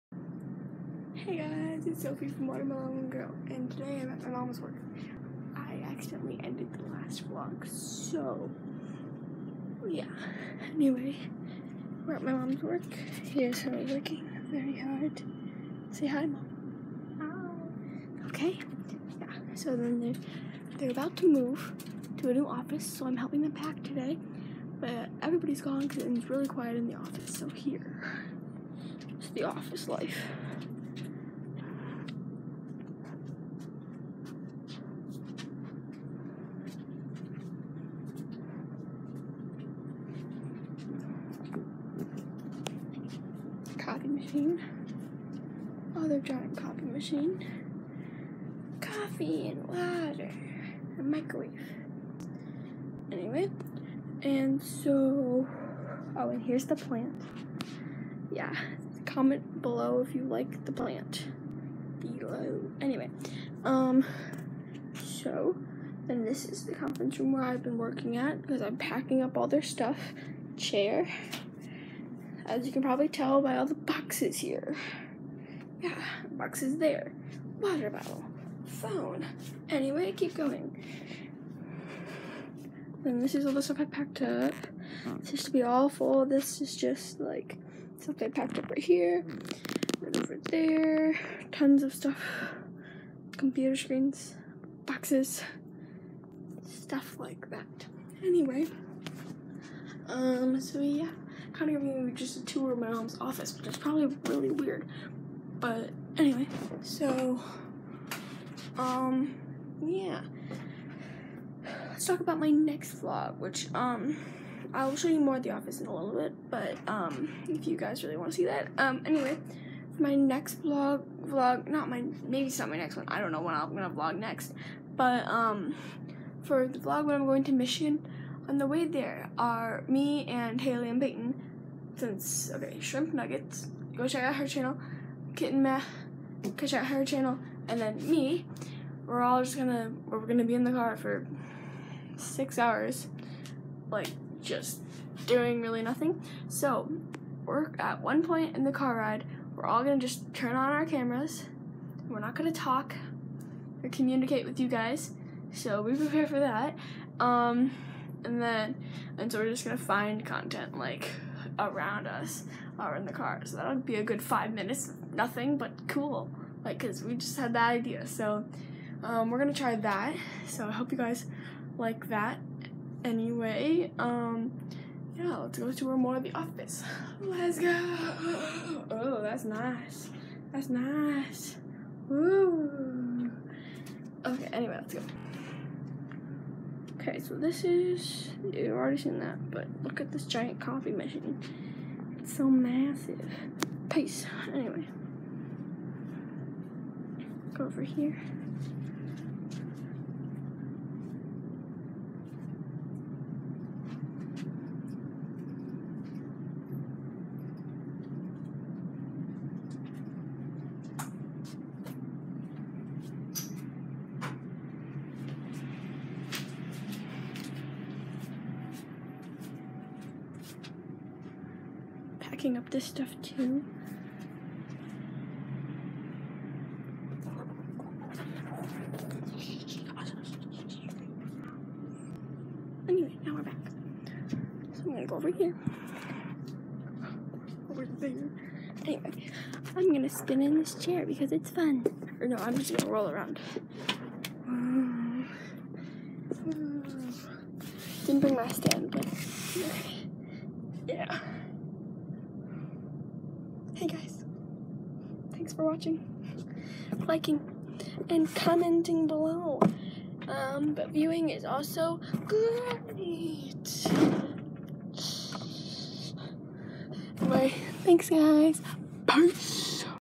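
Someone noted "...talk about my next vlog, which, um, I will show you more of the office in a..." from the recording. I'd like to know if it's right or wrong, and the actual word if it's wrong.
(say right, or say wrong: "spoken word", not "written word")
right.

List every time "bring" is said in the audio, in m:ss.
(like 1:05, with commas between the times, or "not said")
4:08.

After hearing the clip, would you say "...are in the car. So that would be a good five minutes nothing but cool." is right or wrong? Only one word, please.
right.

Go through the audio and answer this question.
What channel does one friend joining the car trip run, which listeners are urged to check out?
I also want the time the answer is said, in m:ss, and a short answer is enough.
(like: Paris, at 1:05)
kitten math, at 2:15.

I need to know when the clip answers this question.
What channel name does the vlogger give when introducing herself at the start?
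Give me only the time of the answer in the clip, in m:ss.
0:02.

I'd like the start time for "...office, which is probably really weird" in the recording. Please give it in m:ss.
1:43.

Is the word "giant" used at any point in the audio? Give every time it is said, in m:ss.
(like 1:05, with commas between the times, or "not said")
0:46, 3:10.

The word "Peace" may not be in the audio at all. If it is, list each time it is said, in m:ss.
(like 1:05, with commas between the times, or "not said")
3:13, 4:29.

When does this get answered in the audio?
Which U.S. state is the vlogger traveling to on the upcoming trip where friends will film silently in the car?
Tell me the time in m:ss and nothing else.
2:07.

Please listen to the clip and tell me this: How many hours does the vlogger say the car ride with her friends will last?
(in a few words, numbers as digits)
6 hours.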